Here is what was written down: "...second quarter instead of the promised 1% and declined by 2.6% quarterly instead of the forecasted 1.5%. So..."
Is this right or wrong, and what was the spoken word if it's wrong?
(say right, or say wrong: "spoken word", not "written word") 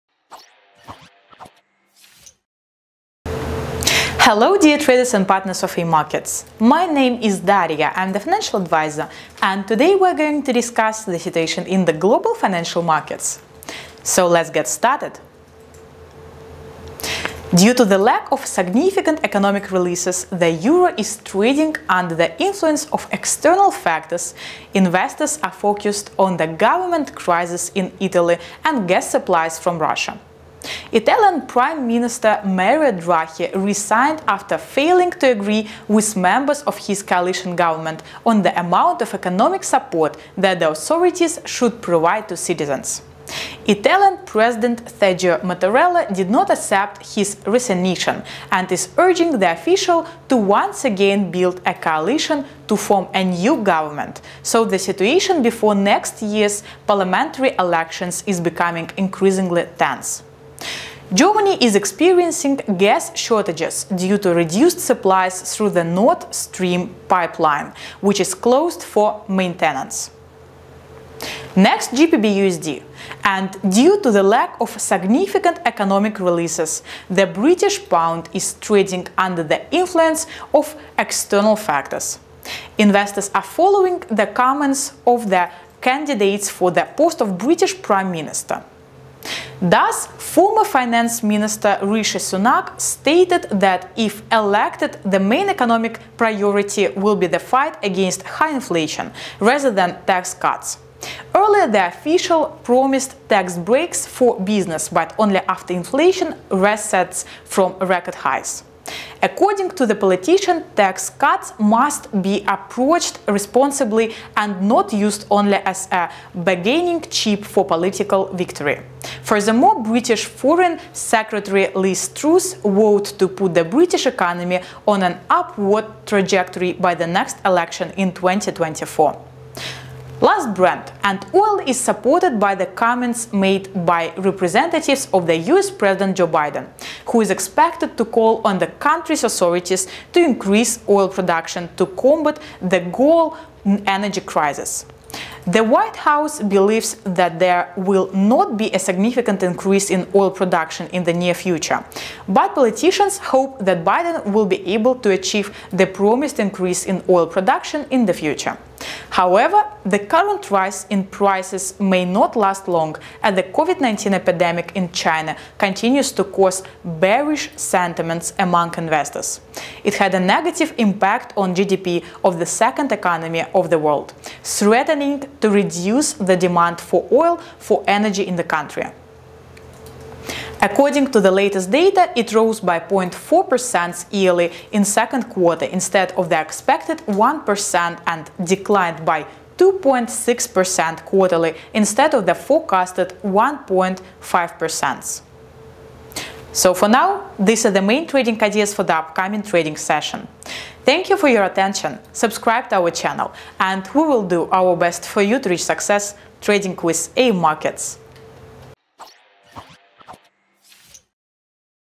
wrong: "expected", not "promised".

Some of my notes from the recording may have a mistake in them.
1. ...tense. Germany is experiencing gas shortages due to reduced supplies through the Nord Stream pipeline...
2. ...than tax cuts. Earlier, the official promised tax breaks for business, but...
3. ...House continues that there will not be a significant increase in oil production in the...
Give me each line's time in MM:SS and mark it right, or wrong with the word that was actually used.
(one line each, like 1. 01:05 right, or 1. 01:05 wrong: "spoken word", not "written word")
1. 00:59 right
2. 01:39 right
3. 02:25 wrong: "believes", not "continues".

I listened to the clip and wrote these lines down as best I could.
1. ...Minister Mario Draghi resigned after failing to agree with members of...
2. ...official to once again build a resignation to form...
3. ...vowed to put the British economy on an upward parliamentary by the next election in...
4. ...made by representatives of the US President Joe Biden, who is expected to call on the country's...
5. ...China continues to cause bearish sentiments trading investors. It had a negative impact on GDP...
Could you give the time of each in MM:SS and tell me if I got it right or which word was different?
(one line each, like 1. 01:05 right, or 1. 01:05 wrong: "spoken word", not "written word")
1. 00:31 right
2. 00:49 wrong: "coalition", not "resignation"
3. 02:02 wrong: "trajectory", not "parliamentary"
4. 02:13 right
5. 02:44 wrong: "among", not "trading".